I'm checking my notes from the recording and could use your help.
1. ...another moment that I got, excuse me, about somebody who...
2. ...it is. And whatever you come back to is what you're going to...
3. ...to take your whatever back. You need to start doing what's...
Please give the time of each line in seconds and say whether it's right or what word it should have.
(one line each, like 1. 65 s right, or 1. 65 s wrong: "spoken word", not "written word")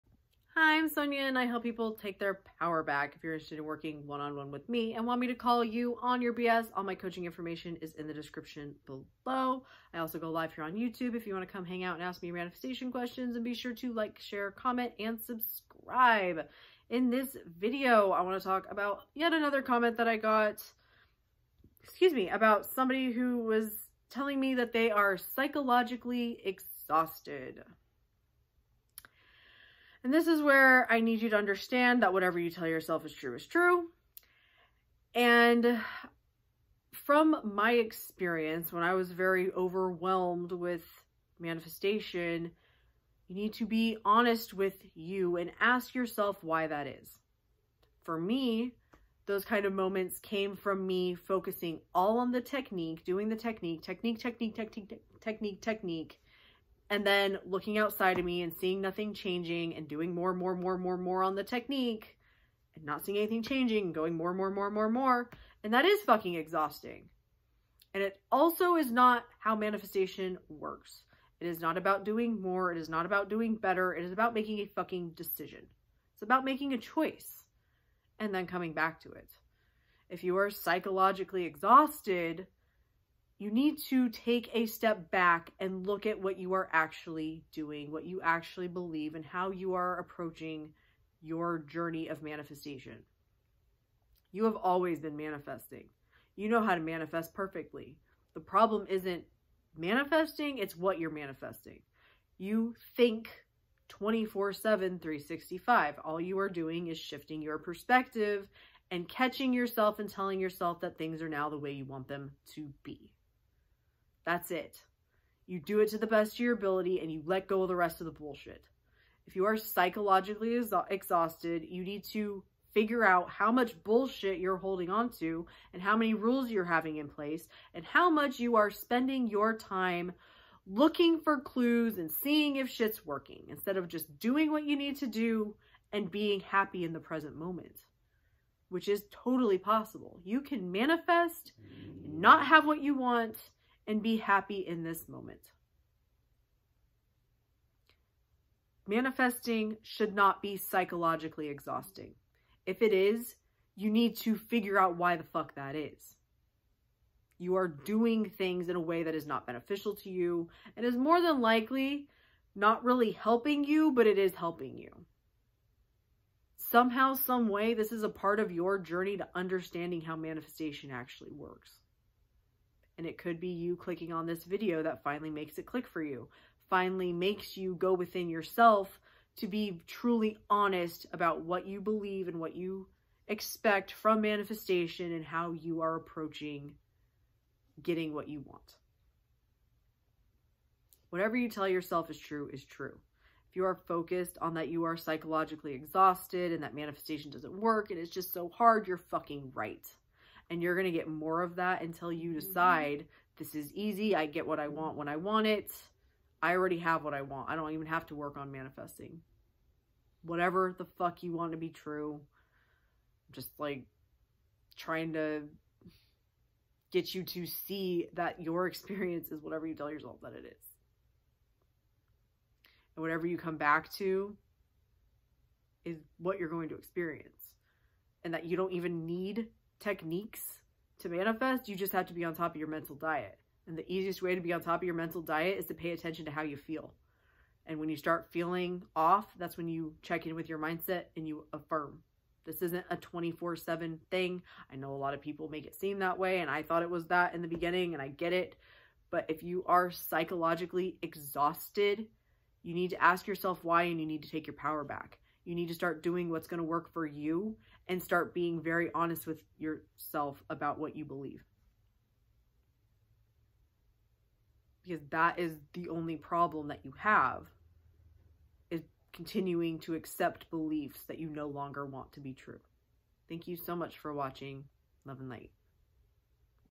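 1. 19 s wrong: "comment", not "moment"
2. 220 s right
3. 254 s wrong: "power", not "whatever".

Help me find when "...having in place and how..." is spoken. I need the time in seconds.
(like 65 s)
126 s.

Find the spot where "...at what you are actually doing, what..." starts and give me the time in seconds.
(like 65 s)
86 s.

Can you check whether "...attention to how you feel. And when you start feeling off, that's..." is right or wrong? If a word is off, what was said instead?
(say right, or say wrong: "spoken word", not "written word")
right.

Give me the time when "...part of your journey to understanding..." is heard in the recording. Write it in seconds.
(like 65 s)
168 s.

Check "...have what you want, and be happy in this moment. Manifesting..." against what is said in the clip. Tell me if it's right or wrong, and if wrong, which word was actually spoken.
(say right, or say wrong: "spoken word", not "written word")
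right.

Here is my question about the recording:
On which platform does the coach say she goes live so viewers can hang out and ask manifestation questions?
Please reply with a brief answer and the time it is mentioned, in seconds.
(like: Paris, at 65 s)
YouTube, at 10 s.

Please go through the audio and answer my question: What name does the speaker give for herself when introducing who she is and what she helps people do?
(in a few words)
Sonja.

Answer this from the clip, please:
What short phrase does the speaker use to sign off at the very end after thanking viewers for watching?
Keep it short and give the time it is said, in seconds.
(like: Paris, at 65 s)
Love and light, at 275 s.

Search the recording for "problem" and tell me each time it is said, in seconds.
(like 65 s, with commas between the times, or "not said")
98 s, 266 s.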